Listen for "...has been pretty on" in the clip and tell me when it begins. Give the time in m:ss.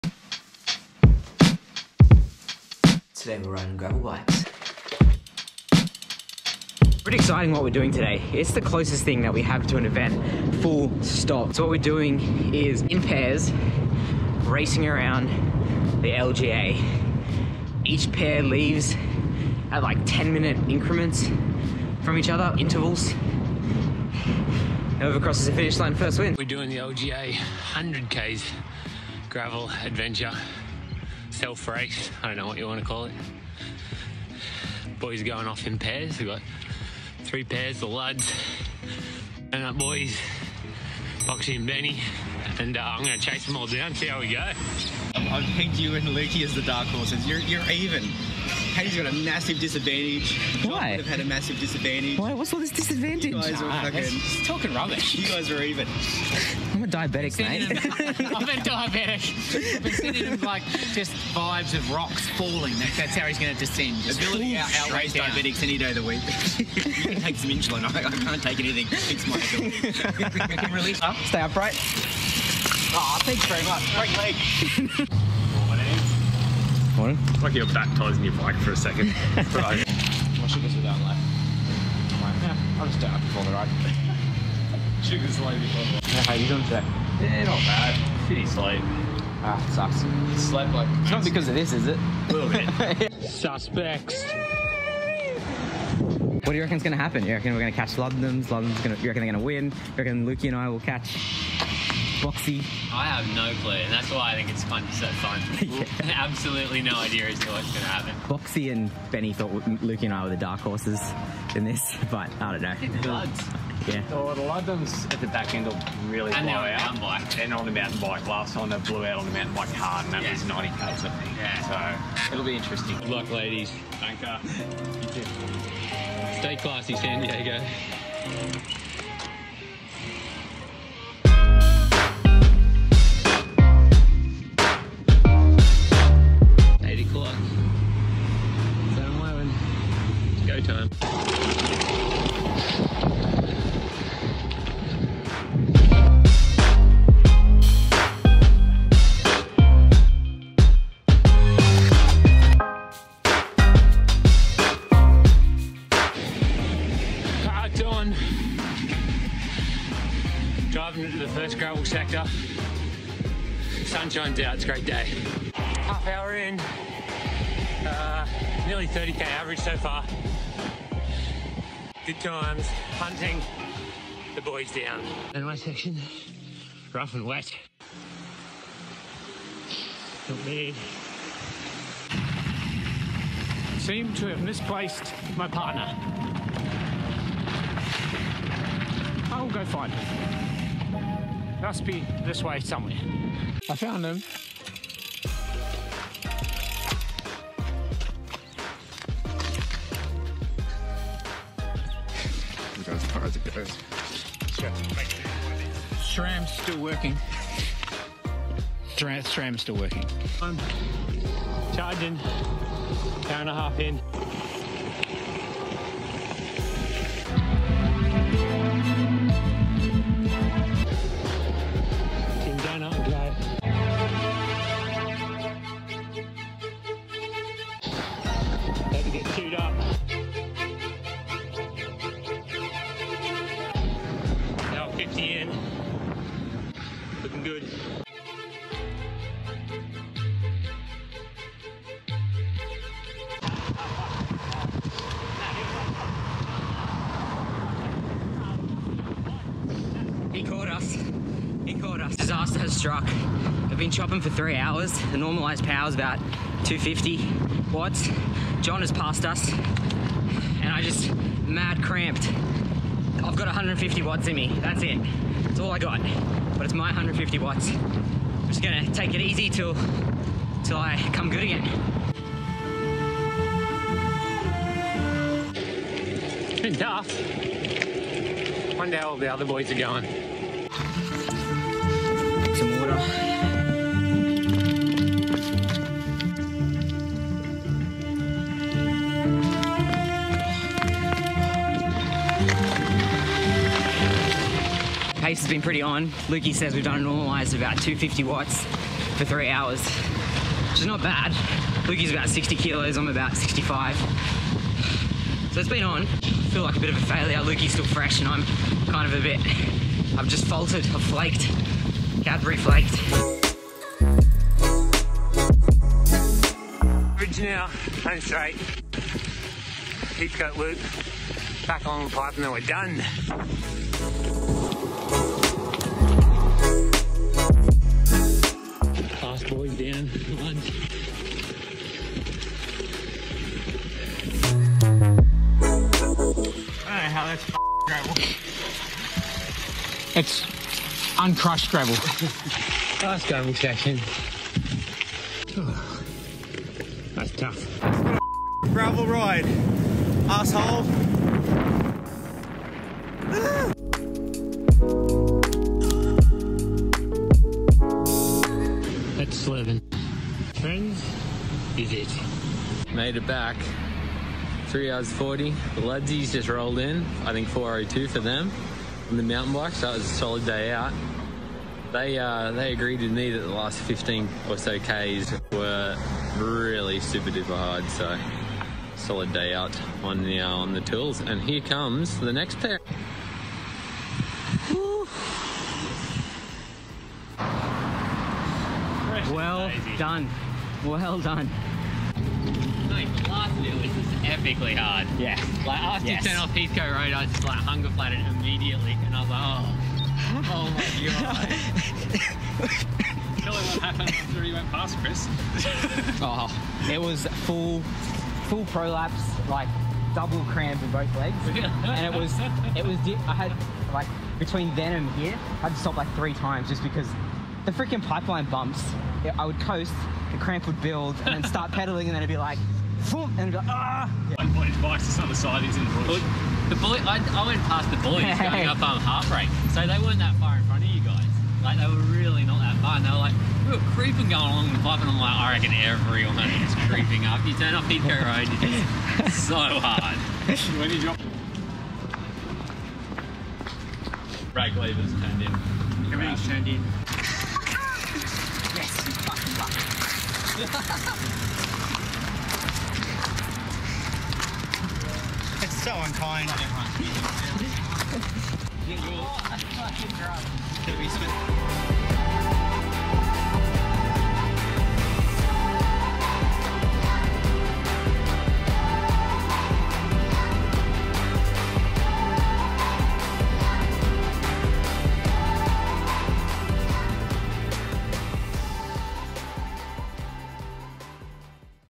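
4:55.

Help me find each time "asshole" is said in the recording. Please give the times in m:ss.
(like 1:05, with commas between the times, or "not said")
5:50.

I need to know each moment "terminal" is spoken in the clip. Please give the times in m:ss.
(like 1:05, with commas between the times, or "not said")
not said.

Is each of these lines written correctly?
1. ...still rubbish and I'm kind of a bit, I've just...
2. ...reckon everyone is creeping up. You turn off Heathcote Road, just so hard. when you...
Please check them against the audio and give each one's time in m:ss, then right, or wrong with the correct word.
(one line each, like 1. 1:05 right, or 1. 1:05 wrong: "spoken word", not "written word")
1. 5:07 wrong: "fresh", not "rubbish"
2. 7:15 right.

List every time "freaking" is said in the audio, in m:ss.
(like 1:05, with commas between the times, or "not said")
6:57.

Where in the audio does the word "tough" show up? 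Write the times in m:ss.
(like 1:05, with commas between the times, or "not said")
4:36, 5:47.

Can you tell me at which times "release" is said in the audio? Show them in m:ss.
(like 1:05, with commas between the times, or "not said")
1:10.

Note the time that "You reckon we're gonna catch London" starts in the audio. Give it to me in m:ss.
1:37.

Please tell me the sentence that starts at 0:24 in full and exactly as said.
Whoever crosses the finish line first wins.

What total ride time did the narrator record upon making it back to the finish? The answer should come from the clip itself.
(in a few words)
3 hours 40.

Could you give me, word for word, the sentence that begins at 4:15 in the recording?
The normalized power is about 250 watts.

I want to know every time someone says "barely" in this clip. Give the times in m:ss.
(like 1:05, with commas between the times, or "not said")
not said.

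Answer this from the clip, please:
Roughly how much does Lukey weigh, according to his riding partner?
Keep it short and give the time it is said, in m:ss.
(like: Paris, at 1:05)
60 kilos, at 5:02.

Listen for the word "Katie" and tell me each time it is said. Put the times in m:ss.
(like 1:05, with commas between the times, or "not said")
0:48.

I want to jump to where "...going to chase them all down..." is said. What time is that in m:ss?
0:43.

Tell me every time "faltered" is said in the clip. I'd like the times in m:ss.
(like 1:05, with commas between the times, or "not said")
5:10.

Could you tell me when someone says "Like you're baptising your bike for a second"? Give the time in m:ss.
1:17.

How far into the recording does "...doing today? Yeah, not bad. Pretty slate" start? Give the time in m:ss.
1:26.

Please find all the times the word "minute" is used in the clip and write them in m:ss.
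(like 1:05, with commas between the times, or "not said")
0:20.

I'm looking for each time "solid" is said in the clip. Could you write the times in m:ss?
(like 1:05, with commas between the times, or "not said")
6:10, 6:18.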